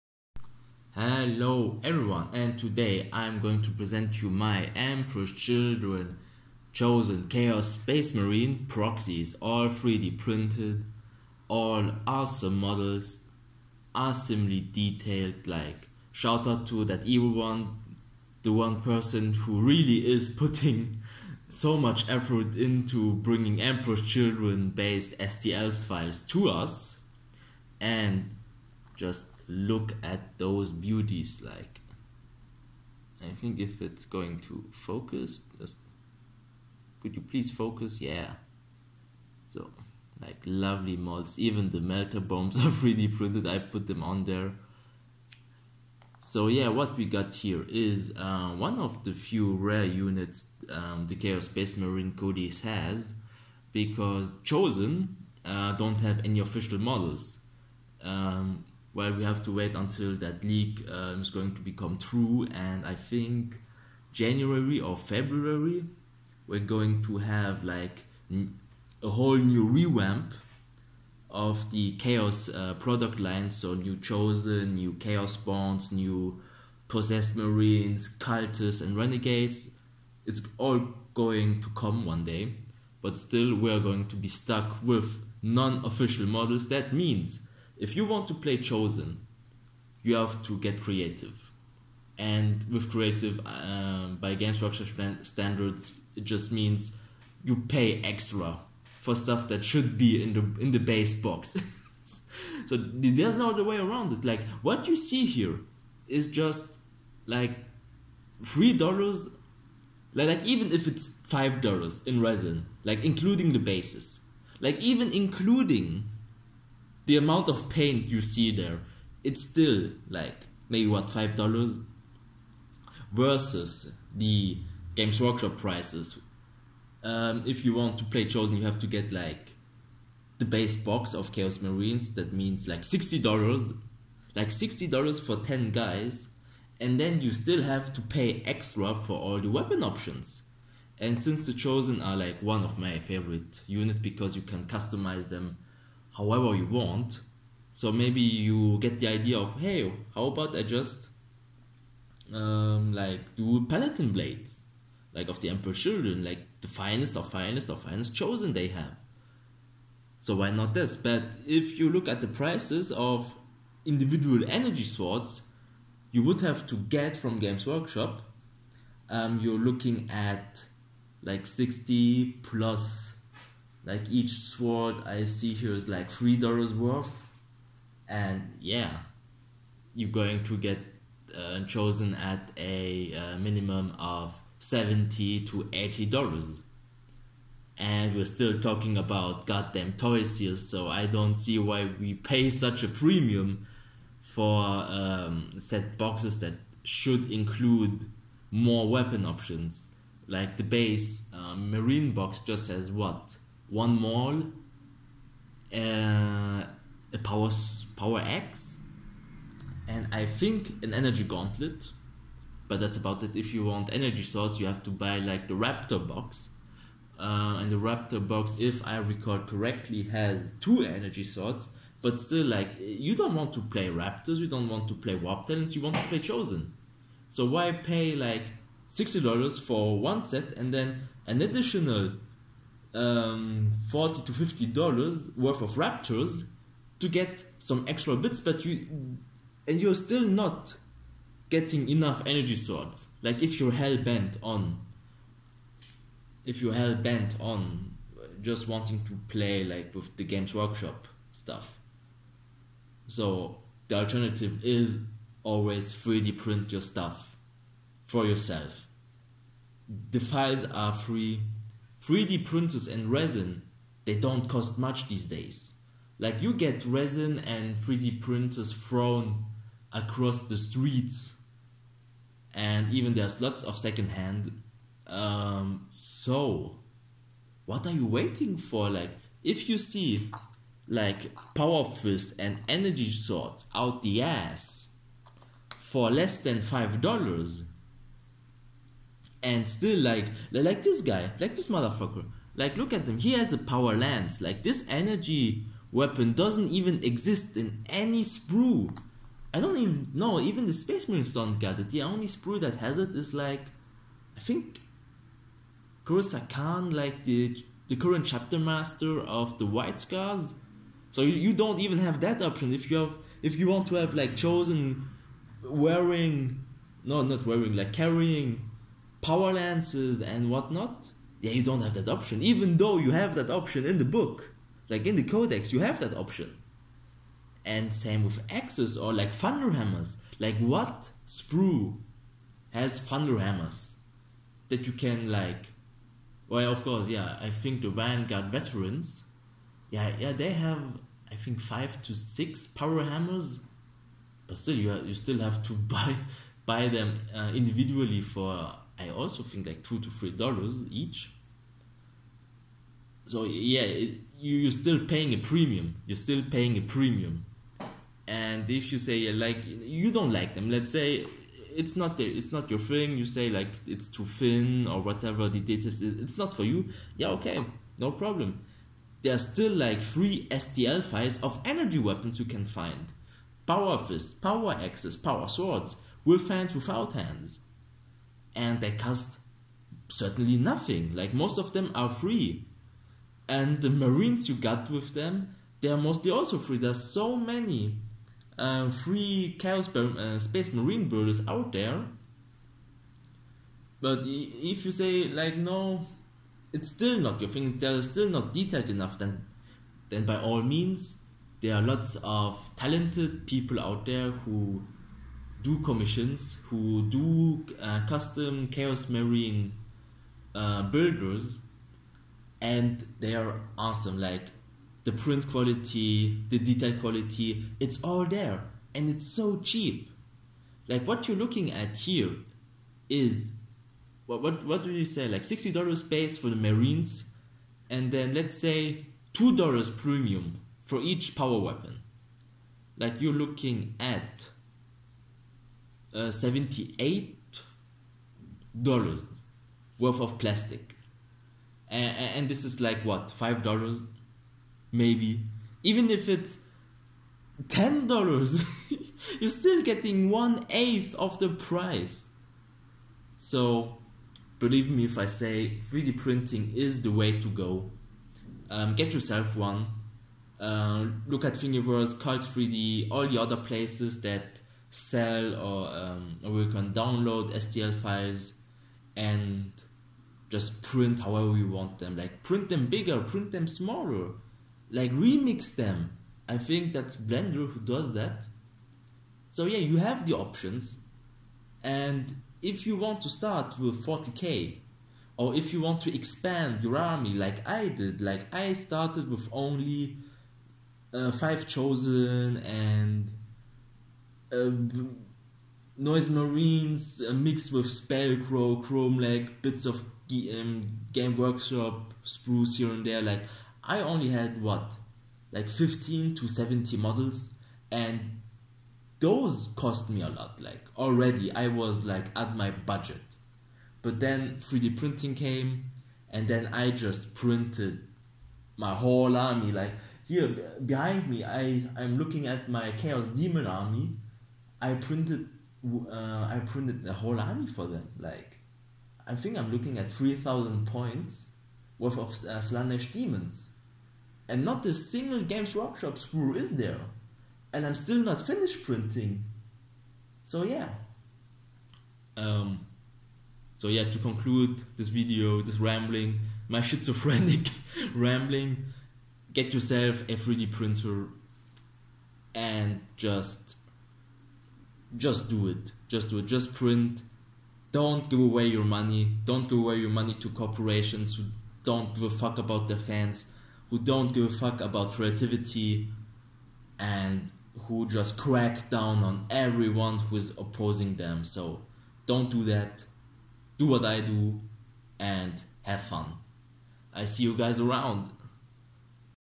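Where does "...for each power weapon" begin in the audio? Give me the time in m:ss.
7:10.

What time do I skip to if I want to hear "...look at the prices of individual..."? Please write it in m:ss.
2:41.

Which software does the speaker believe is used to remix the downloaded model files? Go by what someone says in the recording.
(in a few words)
Blender.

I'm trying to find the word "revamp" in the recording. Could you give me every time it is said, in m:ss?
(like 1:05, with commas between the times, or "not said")
1:09.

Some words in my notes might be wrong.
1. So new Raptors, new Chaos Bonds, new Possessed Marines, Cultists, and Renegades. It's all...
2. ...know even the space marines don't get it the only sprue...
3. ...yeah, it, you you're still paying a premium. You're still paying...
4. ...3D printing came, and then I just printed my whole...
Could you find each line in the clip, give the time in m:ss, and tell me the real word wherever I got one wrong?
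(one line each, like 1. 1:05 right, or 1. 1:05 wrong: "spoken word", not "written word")
1. 1:13 wrong: "Chosen", not "Raptors"
2. 5:00 right
3. 5:53 right
4. 8:34 right.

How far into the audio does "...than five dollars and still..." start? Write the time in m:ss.
4:46.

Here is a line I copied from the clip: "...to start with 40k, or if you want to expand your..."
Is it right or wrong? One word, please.
right.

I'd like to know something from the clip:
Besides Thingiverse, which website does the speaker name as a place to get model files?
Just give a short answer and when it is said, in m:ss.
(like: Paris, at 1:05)
Cult 3D, at 7:42.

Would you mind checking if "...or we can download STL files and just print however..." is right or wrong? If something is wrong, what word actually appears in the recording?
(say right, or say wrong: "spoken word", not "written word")
right.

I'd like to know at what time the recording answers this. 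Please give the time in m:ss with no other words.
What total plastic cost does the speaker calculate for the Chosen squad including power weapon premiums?
7:16.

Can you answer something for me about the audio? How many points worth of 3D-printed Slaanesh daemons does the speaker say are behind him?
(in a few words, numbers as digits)
3000.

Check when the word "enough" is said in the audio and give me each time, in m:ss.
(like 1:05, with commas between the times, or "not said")
4:01, 6:38.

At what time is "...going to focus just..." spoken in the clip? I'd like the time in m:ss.
0:34.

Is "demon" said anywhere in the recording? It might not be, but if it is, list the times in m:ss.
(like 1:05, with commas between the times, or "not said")
8:43, 8:53.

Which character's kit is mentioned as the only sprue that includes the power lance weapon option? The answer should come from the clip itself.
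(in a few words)
Kor'sarro Khan.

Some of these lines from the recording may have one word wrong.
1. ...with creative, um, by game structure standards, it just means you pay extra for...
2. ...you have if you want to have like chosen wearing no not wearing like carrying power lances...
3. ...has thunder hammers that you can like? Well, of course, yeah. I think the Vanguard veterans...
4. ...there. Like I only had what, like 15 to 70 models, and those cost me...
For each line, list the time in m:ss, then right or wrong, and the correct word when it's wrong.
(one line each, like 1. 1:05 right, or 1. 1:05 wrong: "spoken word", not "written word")
1. 1:32 right
2. 5:12 right
3. 5:32 right
4. 8:23 right.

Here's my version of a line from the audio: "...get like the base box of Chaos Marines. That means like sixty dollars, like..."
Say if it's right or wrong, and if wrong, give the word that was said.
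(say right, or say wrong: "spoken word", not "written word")
right.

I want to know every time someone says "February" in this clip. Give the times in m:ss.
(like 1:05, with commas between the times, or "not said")
1:04.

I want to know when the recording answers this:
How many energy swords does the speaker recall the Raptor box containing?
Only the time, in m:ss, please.
3:40.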